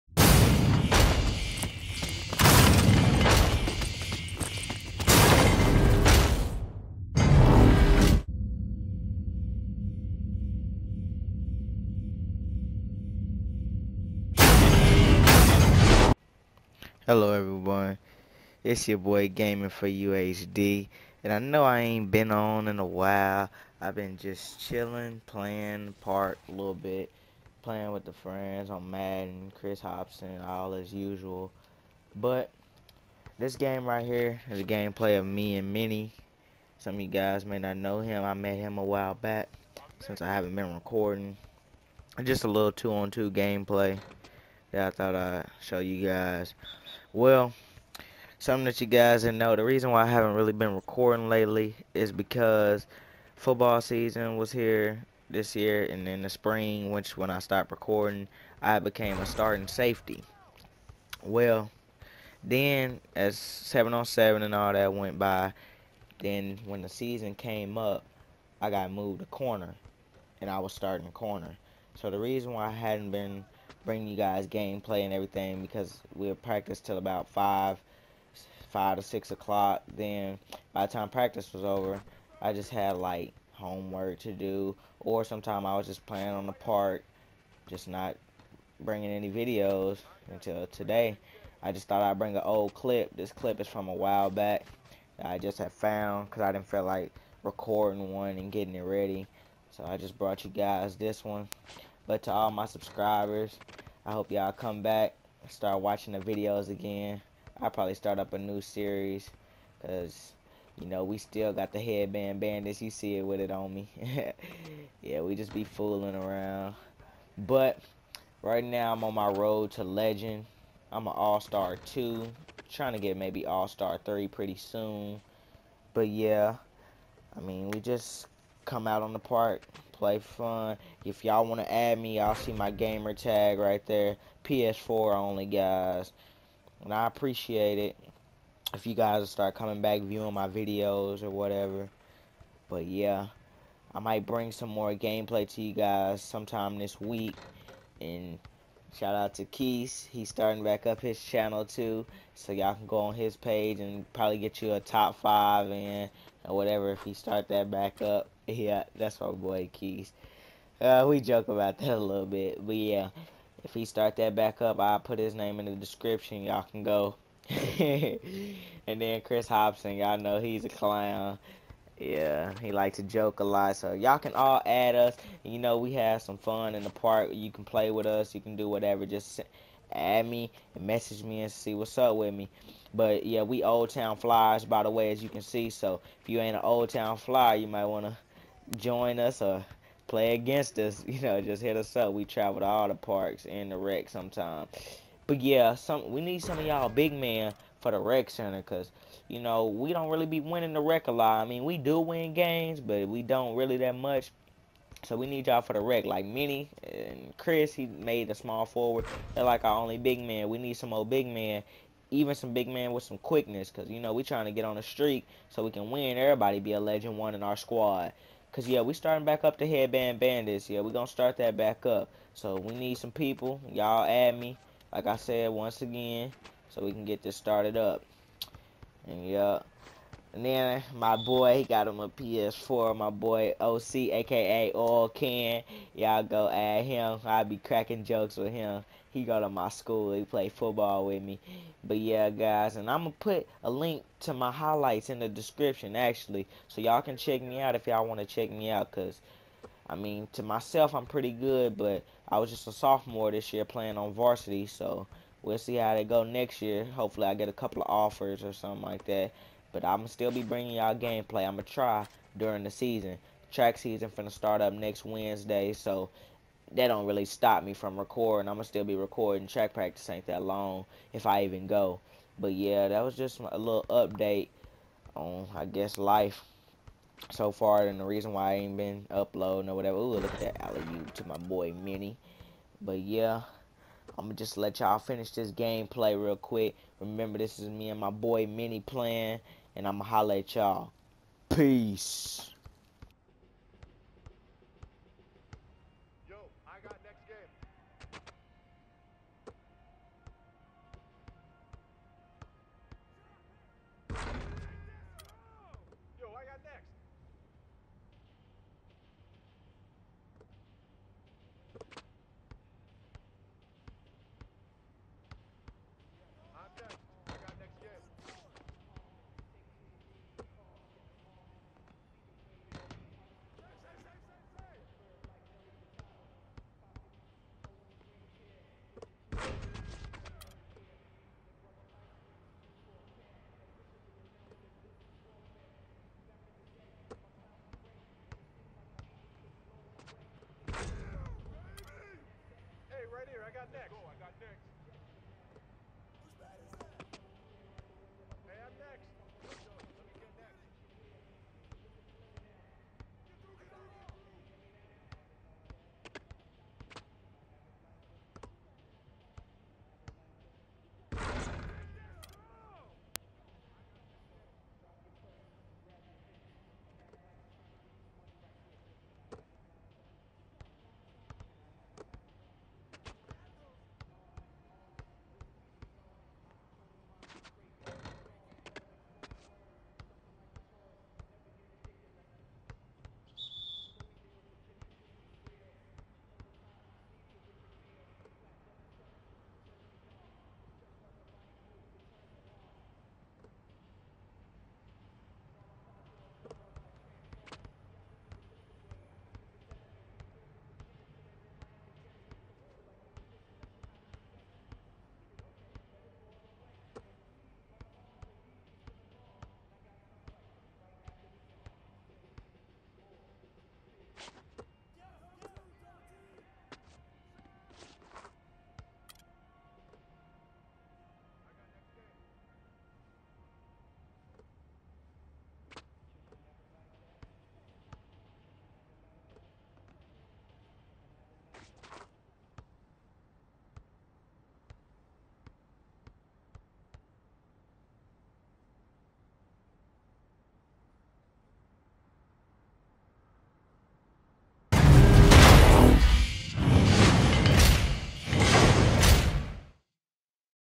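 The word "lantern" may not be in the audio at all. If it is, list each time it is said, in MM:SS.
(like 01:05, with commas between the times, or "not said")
not said.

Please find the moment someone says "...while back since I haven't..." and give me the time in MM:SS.
00:38.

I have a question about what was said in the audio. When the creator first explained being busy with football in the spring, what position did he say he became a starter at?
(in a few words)
Safety.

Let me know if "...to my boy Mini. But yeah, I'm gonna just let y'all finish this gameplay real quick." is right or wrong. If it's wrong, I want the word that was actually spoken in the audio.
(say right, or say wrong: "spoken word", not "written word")
right.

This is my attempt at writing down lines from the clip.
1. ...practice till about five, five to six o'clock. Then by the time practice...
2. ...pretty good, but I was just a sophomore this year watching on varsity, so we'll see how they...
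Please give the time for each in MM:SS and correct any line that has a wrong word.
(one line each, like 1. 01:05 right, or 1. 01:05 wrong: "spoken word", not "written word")
1. 01:16 right
2. 04:11 wrong: "playing", not "watching".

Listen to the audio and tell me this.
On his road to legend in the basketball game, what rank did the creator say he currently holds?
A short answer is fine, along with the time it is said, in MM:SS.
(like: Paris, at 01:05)
All-Star 2, at 02:01.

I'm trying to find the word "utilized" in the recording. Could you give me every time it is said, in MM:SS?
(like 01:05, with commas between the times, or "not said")
not said.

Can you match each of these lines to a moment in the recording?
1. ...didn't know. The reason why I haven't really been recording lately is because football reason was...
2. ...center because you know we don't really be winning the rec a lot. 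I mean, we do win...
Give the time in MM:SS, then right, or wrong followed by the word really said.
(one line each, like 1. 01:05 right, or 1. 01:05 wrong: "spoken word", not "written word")
1. 00:49 wrong: "season", not "reason"
2. 03:18 right.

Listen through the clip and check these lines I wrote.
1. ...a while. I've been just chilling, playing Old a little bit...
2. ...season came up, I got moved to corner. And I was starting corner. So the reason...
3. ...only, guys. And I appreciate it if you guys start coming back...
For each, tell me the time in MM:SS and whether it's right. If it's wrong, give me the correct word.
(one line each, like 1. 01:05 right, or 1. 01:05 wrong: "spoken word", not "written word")
1. 00:22 wrong: "Park", not "Old"
2. 01:06 right
3. 02:15 right.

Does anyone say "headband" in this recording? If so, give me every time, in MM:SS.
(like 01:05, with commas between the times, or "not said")
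01:51, 03:39.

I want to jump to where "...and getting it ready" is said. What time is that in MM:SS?
01:38.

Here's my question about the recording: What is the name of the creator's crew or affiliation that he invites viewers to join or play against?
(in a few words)
Old Town Flyers.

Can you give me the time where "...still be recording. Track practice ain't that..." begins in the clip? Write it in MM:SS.
04:28.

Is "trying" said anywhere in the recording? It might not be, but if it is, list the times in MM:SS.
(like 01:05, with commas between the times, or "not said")
02:02, 03:34.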